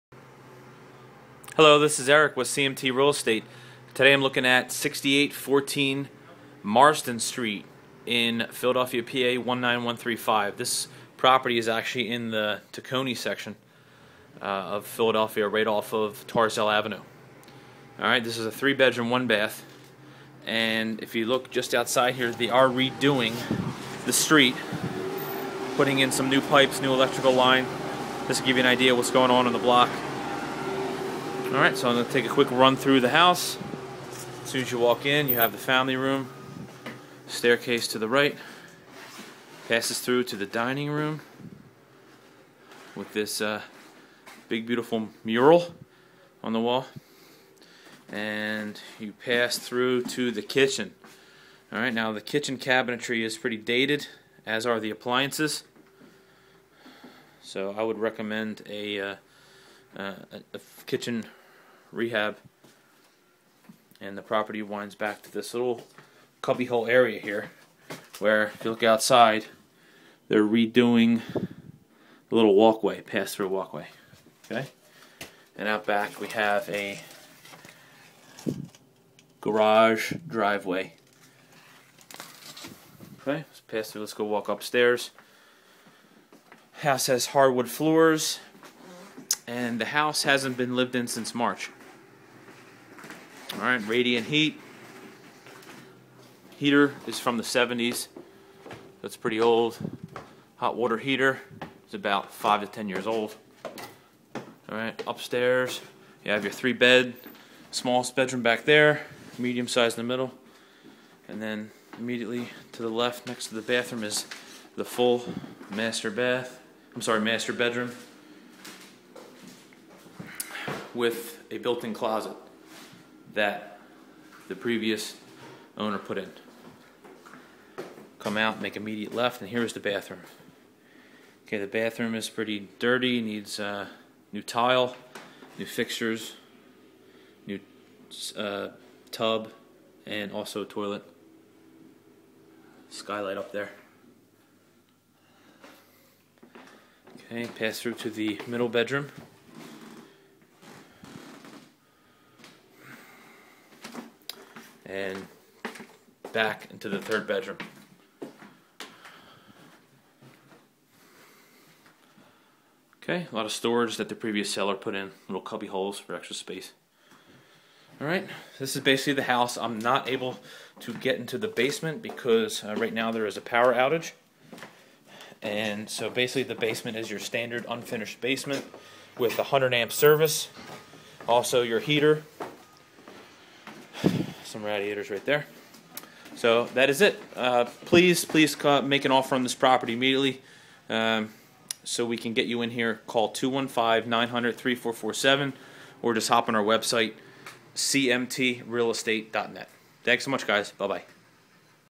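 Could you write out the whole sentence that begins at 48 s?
And you pass through to the kitchen.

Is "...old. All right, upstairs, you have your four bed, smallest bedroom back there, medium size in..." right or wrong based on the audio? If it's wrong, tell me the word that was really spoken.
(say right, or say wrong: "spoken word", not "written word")
wrong: "three", not "four".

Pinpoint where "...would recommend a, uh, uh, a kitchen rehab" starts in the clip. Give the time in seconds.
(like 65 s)
57 s.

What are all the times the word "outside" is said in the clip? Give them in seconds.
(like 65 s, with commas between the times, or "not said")
21 s, 68 s.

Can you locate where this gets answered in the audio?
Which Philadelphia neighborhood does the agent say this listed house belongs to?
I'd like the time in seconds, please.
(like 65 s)
12 s.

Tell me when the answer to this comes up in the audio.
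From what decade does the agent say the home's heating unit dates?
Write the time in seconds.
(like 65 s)
97 s.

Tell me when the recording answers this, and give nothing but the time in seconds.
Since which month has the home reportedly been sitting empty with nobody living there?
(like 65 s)
91 s.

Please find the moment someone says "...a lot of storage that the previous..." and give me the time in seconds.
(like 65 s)
163 s.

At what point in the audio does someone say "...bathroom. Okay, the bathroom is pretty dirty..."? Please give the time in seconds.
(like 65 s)
129 s.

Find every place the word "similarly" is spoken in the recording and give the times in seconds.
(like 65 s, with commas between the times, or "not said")
not said.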